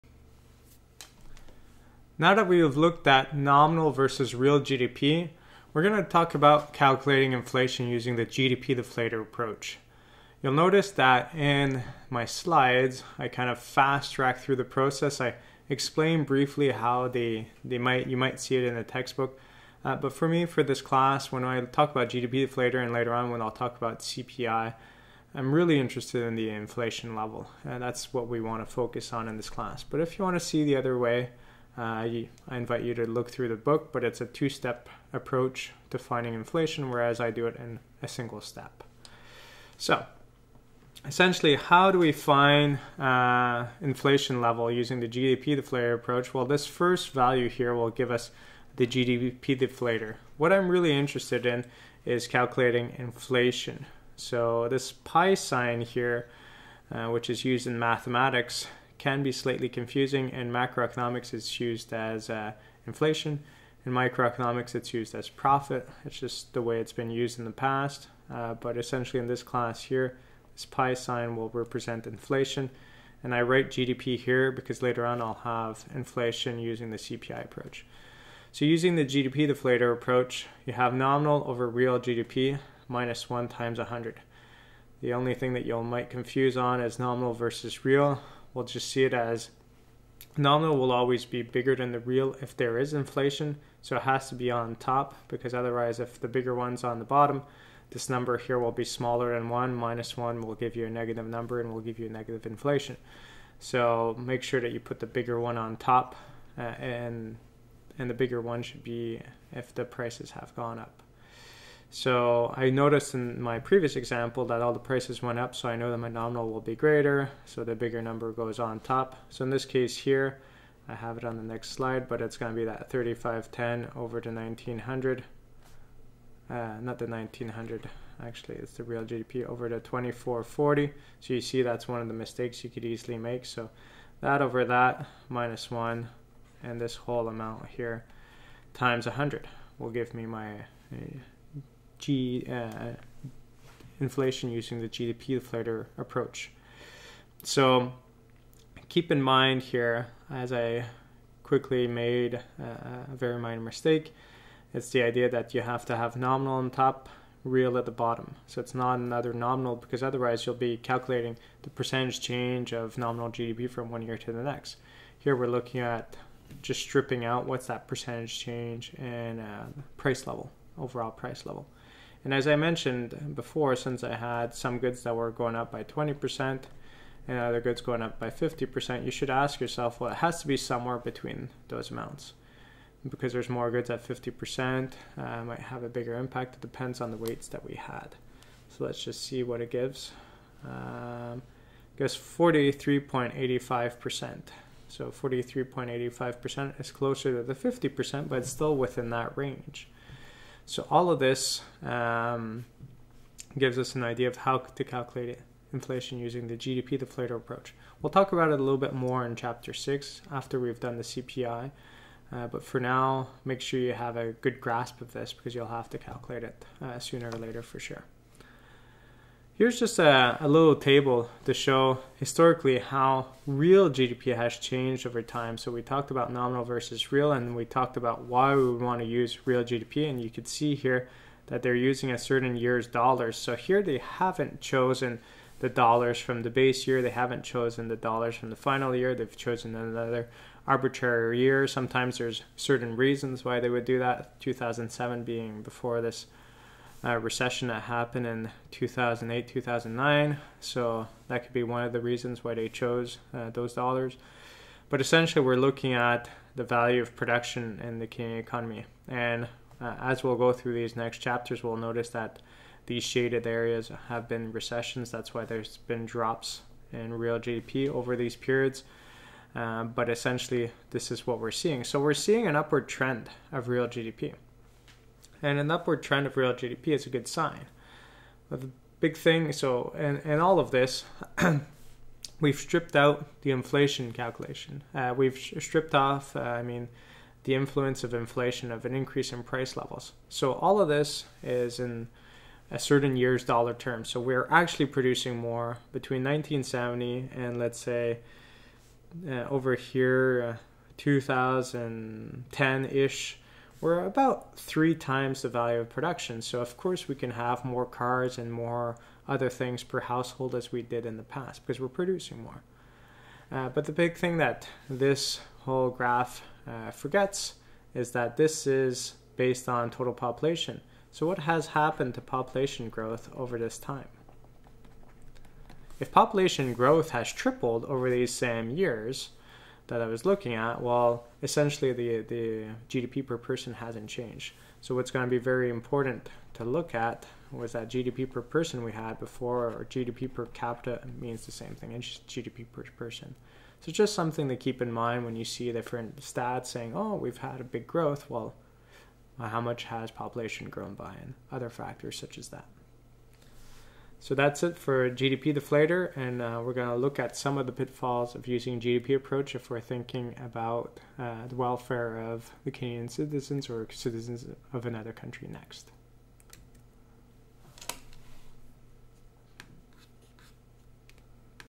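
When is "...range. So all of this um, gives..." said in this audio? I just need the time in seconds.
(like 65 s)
199 s.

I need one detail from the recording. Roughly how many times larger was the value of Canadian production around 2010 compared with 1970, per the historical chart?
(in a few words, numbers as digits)
three times.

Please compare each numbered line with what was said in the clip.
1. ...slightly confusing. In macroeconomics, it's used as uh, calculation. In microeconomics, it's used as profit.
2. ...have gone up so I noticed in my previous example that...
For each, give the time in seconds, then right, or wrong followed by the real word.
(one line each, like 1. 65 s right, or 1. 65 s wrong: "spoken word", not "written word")
1. 59 s wrong: "inflation", not "calculation"
2. 110 s right.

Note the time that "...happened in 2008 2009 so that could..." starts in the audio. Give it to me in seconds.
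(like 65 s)
247 s.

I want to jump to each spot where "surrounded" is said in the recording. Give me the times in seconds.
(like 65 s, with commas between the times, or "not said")
not said.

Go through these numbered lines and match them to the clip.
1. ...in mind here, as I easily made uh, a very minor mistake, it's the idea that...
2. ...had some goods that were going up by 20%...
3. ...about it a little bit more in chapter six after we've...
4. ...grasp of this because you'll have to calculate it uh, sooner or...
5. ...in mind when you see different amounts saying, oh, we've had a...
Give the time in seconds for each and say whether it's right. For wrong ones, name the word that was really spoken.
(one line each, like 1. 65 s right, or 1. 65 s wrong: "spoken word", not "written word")
1. 149 s wrong: "quickly", not "easily"
2. 174 s right
3. 208 s right
4. 214 s right
5. 344 s wrong: "stats", not "amounts".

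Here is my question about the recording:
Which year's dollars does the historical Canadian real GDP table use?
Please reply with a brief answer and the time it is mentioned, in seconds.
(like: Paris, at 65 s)
2007, at 244 s.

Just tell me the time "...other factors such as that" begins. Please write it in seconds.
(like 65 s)
351 s.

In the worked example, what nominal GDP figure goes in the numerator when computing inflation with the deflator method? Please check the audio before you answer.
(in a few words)
3510.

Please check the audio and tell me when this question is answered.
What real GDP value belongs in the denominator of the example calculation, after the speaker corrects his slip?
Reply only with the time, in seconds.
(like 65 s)
129 s.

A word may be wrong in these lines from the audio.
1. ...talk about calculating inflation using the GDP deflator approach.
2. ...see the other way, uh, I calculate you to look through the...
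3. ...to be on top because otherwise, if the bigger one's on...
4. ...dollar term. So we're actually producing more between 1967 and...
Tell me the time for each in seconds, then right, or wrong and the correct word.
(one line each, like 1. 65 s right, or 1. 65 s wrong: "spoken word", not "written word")
1. 6 s right
2. 30 s wrong: "invite", not "calculate"
3. 94 s right
4. 293 s wrong: "1970", not "1967".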